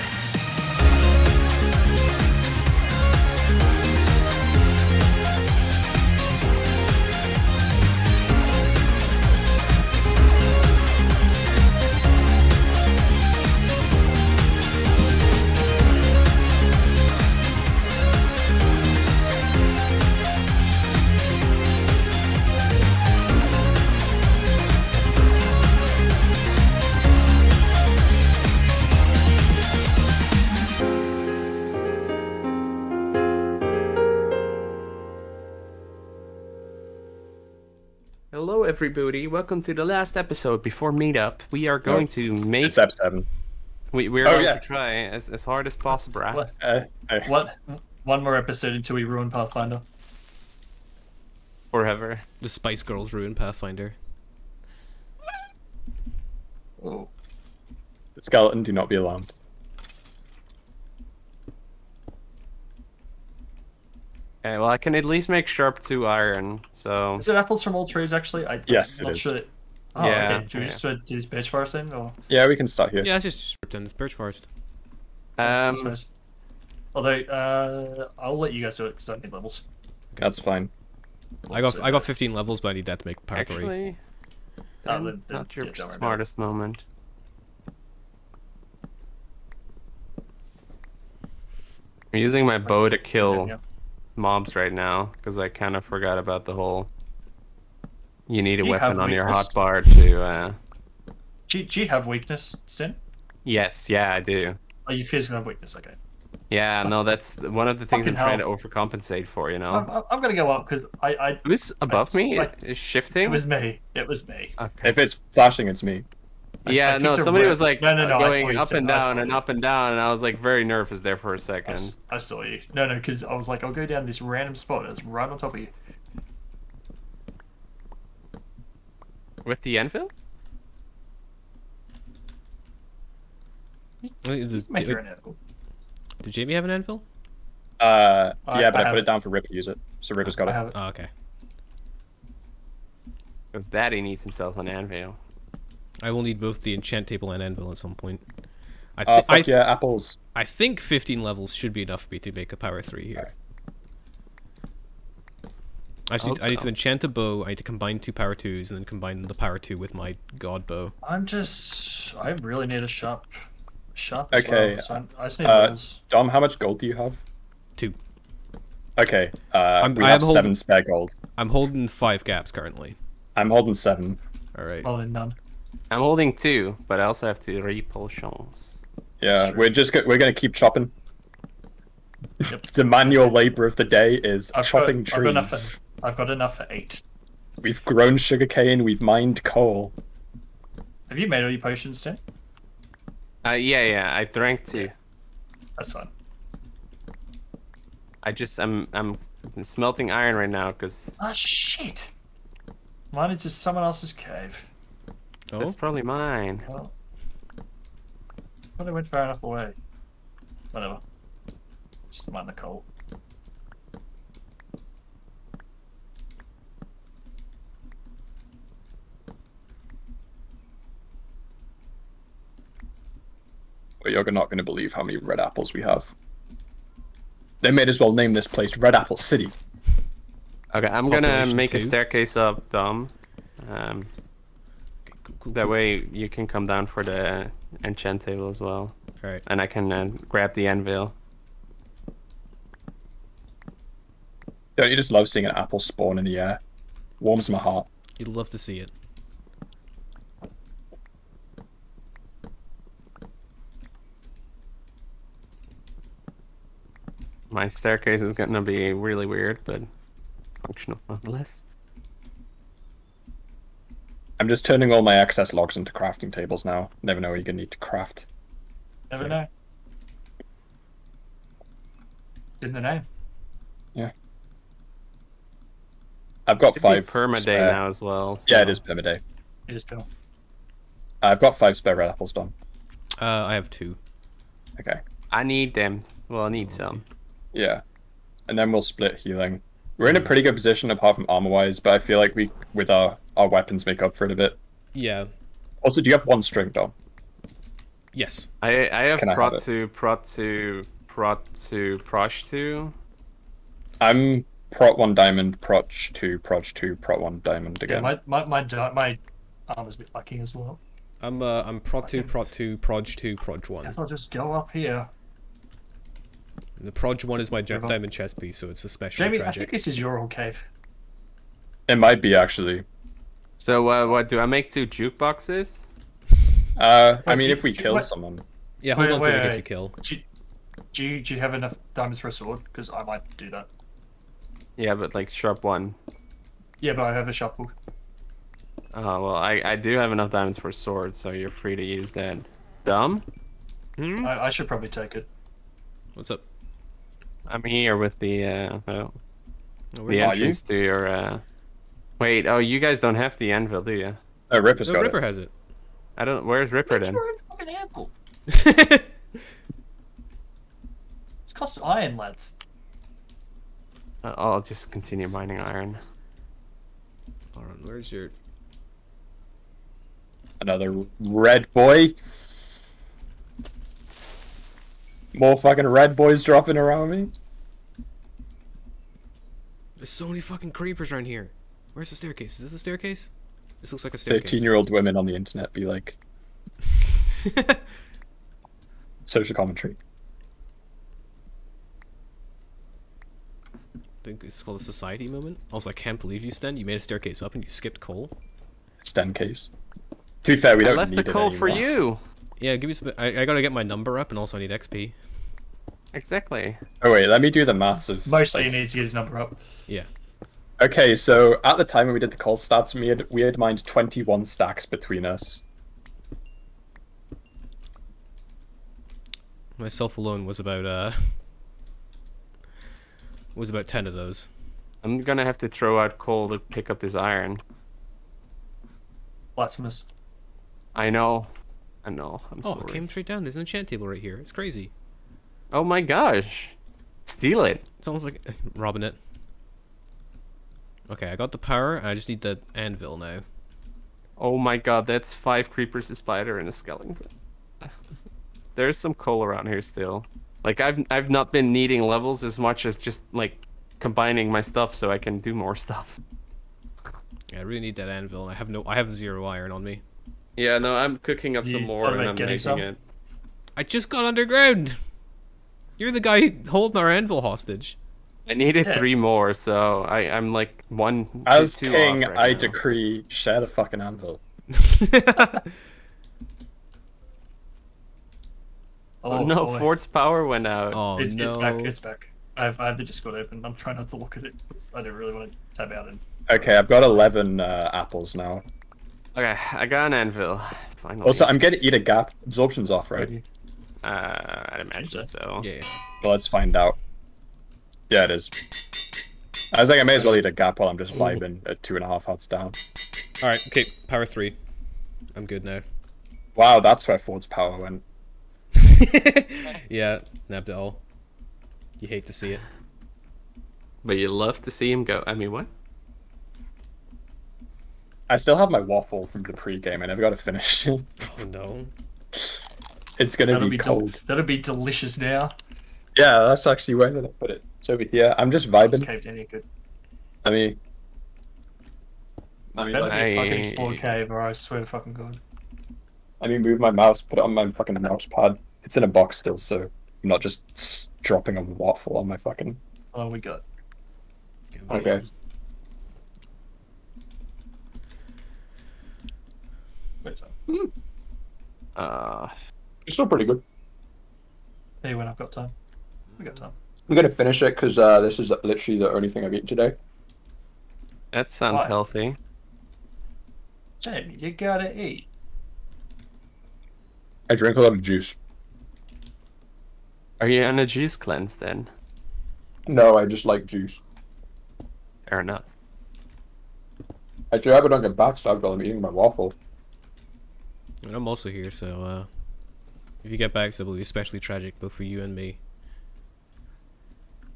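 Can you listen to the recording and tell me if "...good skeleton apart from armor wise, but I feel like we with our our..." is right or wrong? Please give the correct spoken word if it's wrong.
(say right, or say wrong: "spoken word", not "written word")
wrong: "position", not "skeleton".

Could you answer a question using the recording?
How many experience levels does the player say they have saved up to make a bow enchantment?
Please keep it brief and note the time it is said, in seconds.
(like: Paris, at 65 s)
15, at 81 s.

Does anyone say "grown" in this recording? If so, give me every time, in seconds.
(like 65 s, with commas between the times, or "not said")
187 s.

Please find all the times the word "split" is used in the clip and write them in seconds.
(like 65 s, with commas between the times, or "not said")
288 s.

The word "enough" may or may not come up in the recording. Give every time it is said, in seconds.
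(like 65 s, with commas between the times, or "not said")
151 s, 186 s, 209 s, 331 s, 340 s, 575 s.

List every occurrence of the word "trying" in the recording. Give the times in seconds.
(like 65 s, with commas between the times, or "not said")
108 s, 483 s.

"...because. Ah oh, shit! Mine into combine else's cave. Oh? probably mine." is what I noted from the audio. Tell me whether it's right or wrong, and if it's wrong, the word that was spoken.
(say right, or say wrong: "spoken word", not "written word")
wrong: "someone", not "combine".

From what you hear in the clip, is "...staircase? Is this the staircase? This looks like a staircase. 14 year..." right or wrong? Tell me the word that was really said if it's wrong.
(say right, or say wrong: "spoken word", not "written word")
wrong: "13", not "14".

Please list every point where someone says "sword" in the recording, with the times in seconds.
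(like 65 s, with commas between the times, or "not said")
332 s, 340 s.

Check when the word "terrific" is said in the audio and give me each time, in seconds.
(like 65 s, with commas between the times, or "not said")
not said.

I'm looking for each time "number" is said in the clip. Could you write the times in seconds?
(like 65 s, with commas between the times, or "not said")
403 s, 409 s.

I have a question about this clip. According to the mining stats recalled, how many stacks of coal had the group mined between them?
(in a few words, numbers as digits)
21.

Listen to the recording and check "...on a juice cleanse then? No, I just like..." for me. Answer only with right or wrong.
right.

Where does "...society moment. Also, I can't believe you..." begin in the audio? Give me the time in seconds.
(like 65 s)
394 s.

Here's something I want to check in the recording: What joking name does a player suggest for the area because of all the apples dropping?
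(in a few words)
Red Apple City.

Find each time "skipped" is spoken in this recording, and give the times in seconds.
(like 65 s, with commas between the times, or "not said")
397 s.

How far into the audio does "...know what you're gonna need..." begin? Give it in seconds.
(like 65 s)
267 s.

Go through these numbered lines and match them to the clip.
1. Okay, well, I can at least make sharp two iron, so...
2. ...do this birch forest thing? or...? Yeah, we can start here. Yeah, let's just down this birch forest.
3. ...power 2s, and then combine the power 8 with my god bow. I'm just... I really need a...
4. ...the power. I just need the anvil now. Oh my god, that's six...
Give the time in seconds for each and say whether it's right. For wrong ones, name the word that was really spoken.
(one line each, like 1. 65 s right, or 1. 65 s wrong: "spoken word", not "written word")
1. 64 s right
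2. 70 s right
3. 158 s wrong: "2", not "8"
4. 441 s wrong: "five", not "six".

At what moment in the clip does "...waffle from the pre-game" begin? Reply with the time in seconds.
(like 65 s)
518 s.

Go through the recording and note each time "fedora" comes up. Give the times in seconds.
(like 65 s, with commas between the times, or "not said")
not said.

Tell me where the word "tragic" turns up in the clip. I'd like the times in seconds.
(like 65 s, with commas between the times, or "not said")
319 s, 584 s.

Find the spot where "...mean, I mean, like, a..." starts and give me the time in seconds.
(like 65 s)
530 s.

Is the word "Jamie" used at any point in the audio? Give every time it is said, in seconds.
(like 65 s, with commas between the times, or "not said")
136 s, 319 s.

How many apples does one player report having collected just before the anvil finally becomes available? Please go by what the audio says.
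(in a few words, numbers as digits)
11.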